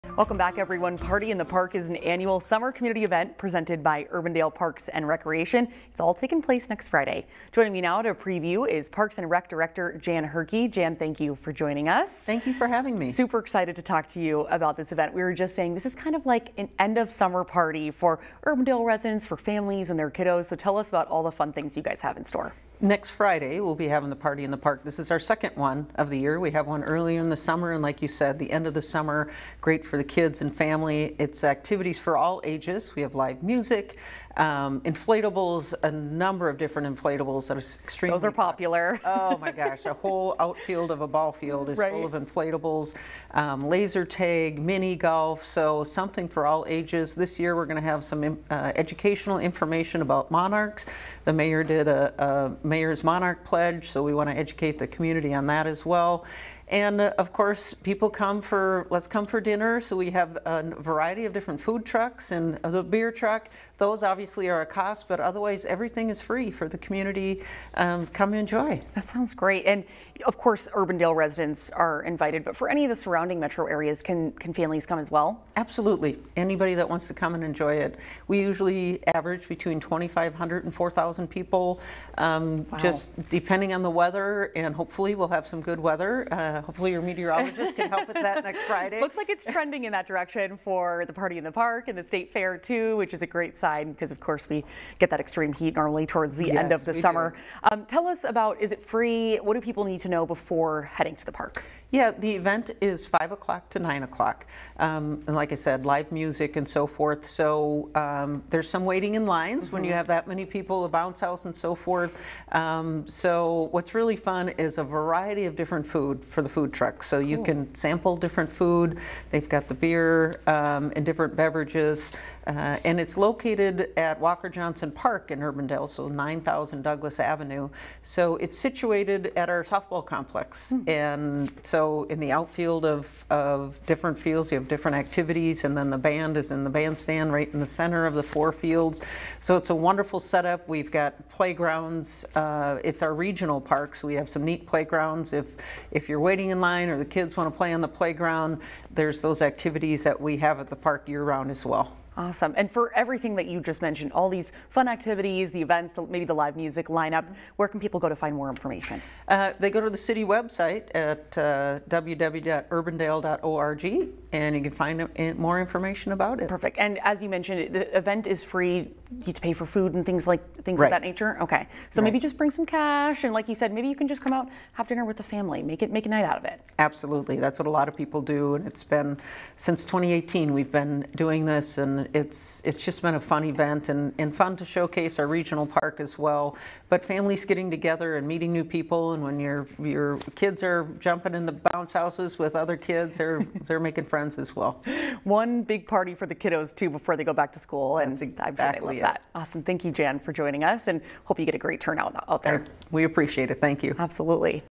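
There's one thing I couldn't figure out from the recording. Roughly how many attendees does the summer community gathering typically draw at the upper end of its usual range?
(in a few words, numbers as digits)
4,000.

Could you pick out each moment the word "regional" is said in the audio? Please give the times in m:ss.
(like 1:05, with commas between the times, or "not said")
2:23, 3:05.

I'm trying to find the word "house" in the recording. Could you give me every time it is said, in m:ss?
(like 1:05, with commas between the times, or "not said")
1:51, 3:11.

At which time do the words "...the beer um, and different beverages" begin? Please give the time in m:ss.
1:59.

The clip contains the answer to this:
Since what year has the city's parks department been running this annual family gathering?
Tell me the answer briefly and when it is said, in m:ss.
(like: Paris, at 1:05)
2018, at 2:59.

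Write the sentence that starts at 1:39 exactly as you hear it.
What do people need to know before heading to the park?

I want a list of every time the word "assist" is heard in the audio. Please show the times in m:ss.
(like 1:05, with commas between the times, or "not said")
not said.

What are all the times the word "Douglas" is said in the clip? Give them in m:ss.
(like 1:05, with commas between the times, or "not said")
2:06.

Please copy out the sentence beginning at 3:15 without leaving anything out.
One big party for the kiddos, too, before they go back to school, and i exactly sure that.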